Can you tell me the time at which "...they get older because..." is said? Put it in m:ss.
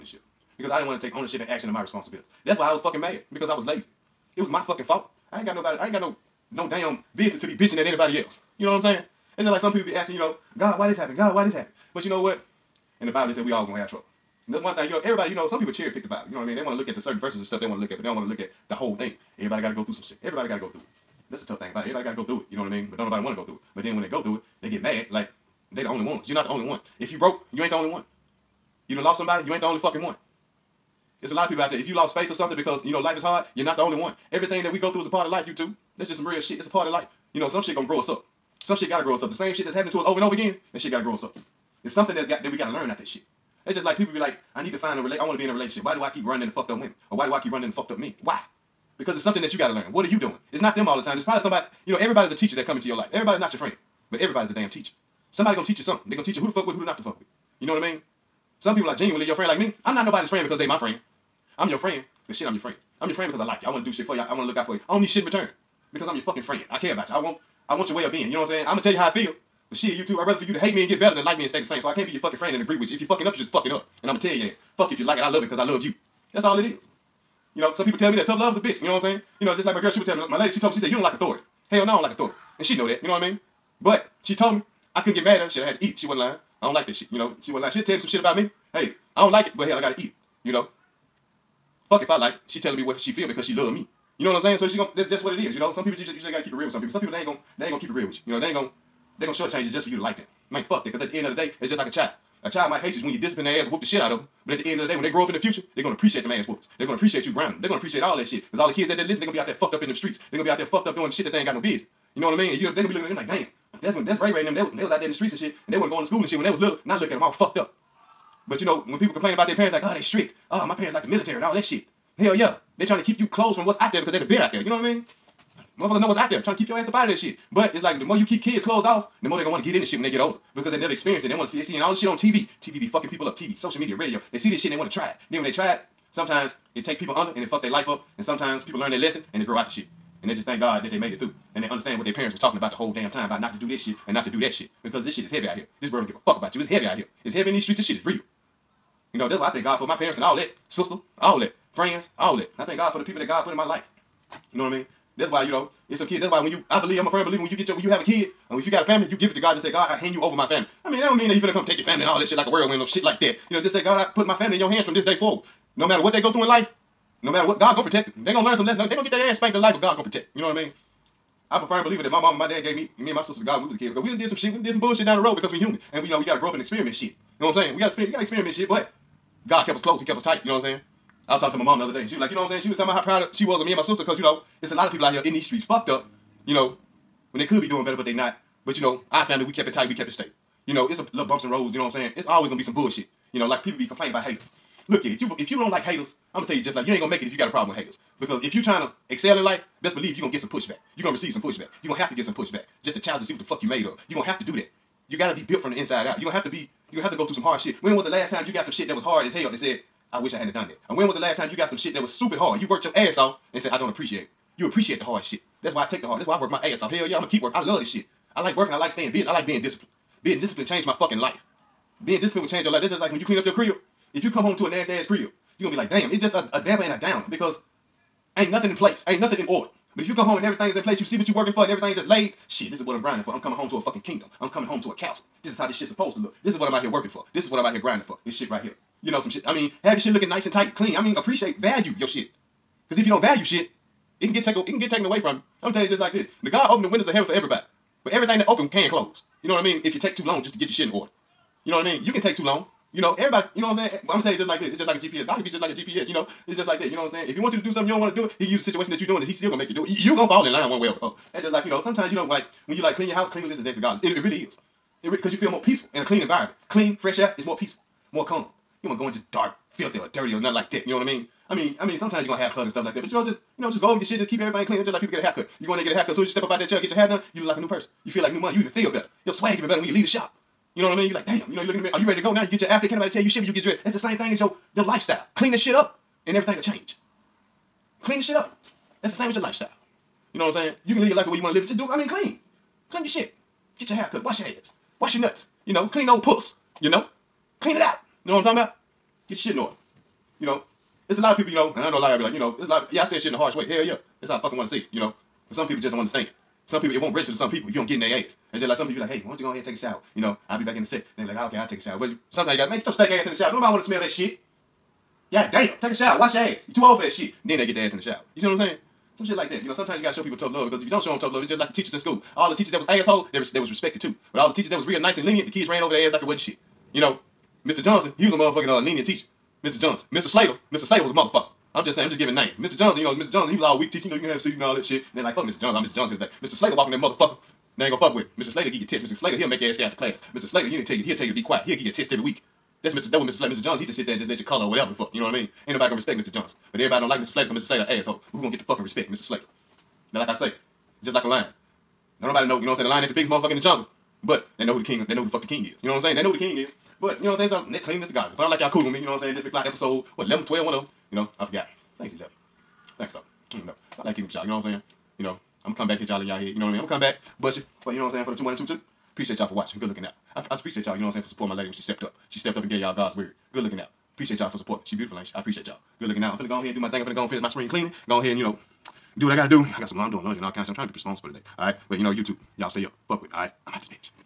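2:10.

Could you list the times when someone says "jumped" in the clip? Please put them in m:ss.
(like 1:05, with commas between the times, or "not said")
not said.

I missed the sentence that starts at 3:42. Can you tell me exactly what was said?
Being disciplined will change your life.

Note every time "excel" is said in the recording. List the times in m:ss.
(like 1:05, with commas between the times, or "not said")
3:19.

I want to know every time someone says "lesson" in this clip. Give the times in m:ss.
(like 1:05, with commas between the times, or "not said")
2:18, 2:48.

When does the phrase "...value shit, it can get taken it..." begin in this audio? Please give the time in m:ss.
4:03.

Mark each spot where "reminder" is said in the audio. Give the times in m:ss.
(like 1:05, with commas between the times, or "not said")
not said.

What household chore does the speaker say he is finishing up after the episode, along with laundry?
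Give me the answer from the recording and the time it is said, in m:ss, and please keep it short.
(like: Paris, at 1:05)
spring cleaning, at 6:17.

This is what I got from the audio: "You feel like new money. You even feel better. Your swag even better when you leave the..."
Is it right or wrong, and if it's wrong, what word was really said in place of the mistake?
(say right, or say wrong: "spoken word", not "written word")
right.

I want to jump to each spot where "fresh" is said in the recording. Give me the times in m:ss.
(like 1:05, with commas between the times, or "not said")
4:26.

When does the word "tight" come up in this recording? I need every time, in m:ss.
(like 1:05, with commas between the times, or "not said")
3:00, 3:09, 4:00.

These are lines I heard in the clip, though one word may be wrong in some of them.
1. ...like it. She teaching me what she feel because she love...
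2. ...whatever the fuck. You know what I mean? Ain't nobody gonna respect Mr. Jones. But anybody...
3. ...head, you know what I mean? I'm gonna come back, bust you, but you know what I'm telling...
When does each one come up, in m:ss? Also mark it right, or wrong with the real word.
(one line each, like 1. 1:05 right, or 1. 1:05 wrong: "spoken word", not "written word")
1. 1:32 wrong: "telling", not "teaching"
2. 5:44 wrong: "everybody", not "anybody"
3. 6:06 wrong: "saying", not "telling".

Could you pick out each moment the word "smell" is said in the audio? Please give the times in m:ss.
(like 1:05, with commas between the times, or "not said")
5:13.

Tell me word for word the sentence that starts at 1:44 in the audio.
But at the end of the day, when they grow up in the future, they're gonna appreciate them ass whoopers.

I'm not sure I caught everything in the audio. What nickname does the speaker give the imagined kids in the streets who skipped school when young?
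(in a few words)
Ray Ray.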